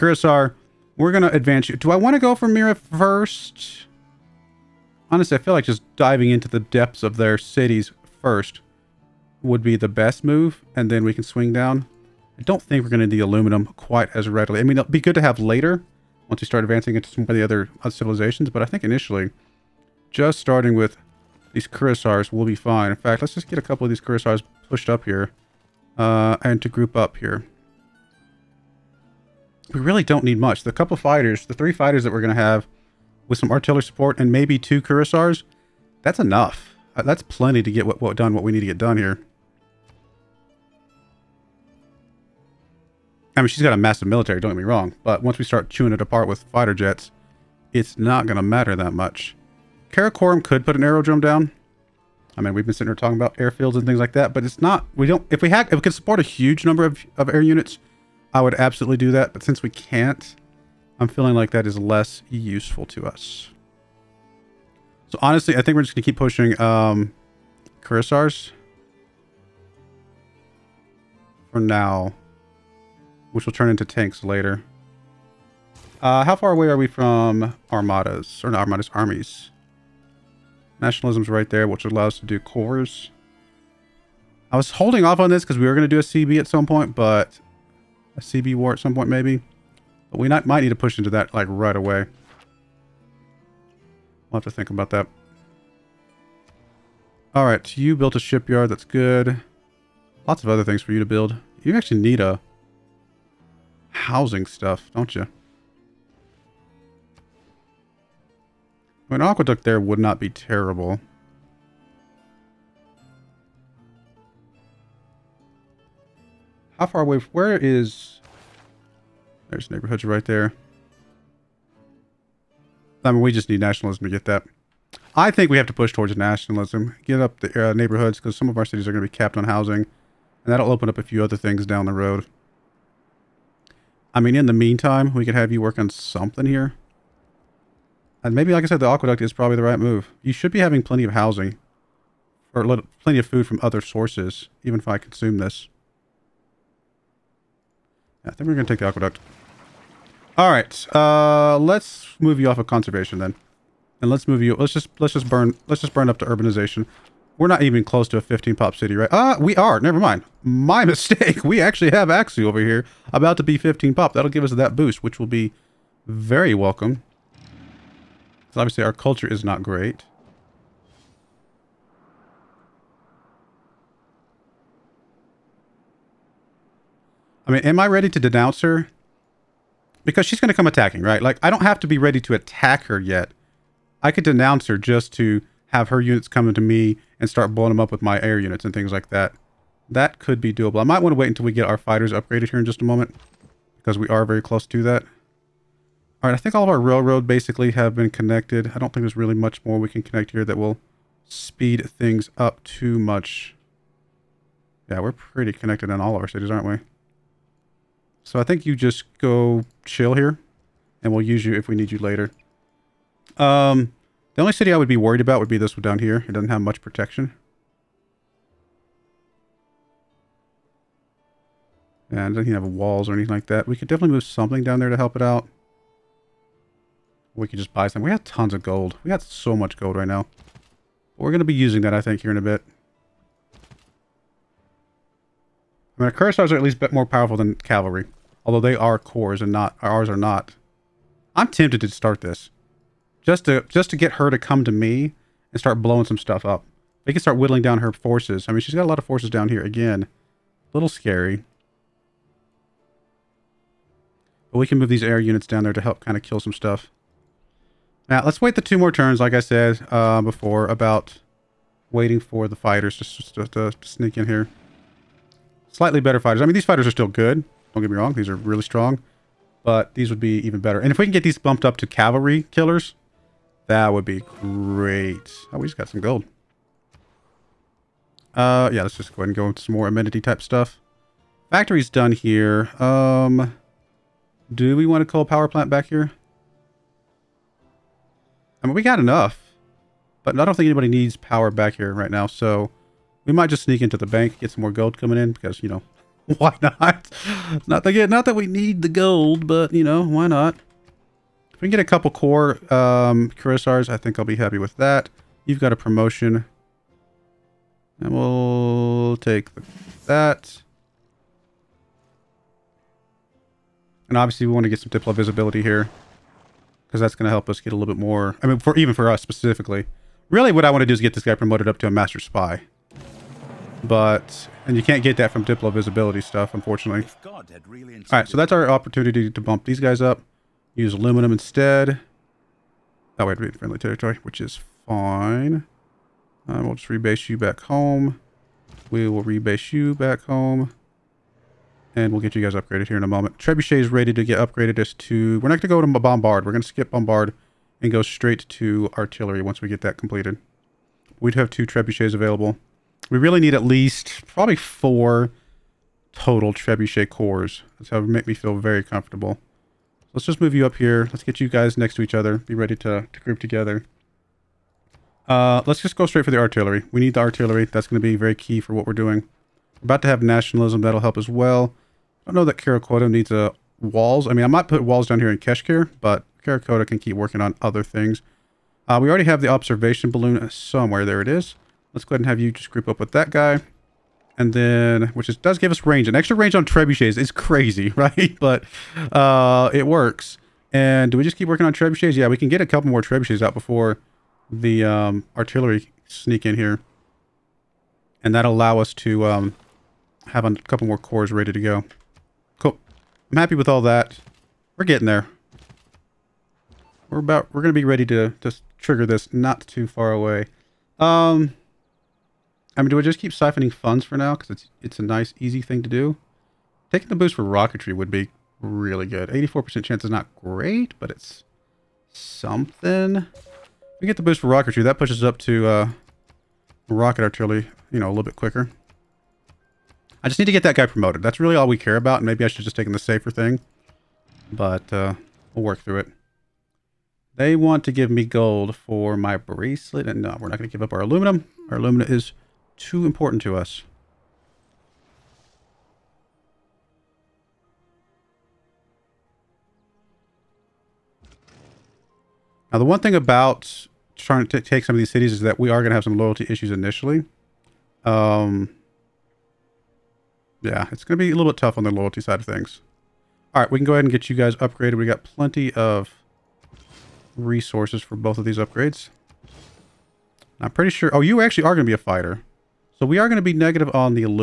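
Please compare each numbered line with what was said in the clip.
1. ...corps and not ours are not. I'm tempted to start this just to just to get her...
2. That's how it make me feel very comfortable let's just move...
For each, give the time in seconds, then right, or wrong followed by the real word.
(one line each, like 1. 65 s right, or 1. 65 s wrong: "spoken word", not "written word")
1. 238 s right
2. 357 s right.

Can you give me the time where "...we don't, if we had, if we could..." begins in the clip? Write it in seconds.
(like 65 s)
54 s.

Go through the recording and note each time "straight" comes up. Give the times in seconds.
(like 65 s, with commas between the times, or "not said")
348 s, 366 s.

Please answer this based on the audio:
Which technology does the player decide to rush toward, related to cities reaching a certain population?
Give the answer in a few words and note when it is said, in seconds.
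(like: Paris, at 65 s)
Urbanization, at 156 s.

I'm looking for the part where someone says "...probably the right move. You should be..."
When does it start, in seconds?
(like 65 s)
139 s.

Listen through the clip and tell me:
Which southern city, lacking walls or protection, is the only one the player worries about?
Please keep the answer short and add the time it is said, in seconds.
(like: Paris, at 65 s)
Keshkir, at 375 s.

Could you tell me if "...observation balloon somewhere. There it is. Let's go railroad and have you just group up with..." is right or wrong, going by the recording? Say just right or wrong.
wrong.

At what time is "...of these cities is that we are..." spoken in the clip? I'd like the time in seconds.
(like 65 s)
454 s.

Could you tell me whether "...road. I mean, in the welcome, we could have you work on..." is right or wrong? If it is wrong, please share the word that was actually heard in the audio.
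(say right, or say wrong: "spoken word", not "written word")
wrong: "meantime", not "welcome".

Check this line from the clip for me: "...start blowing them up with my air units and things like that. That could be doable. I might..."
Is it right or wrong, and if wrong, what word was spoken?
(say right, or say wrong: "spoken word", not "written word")
right.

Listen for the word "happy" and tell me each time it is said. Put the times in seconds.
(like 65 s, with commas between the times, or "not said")
304 s, 403 s.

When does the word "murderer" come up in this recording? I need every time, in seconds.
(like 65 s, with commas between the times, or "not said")
not said.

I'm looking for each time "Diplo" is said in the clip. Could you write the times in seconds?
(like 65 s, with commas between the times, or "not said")
314 s, 325 s.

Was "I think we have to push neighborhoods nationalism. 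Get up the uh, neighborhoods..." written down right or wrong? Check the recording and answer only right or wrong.
wrong.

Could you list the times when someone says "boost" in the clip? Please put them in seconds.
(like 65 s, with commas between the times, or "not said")
164 s, 417 s, 424 s.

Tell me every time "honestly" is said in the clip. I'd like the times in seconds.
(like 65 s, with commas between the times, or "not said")
5 s, 65 s.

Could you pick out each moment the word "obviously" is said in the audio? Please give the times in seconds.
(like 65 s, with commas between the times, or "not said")
168 s, 314 s.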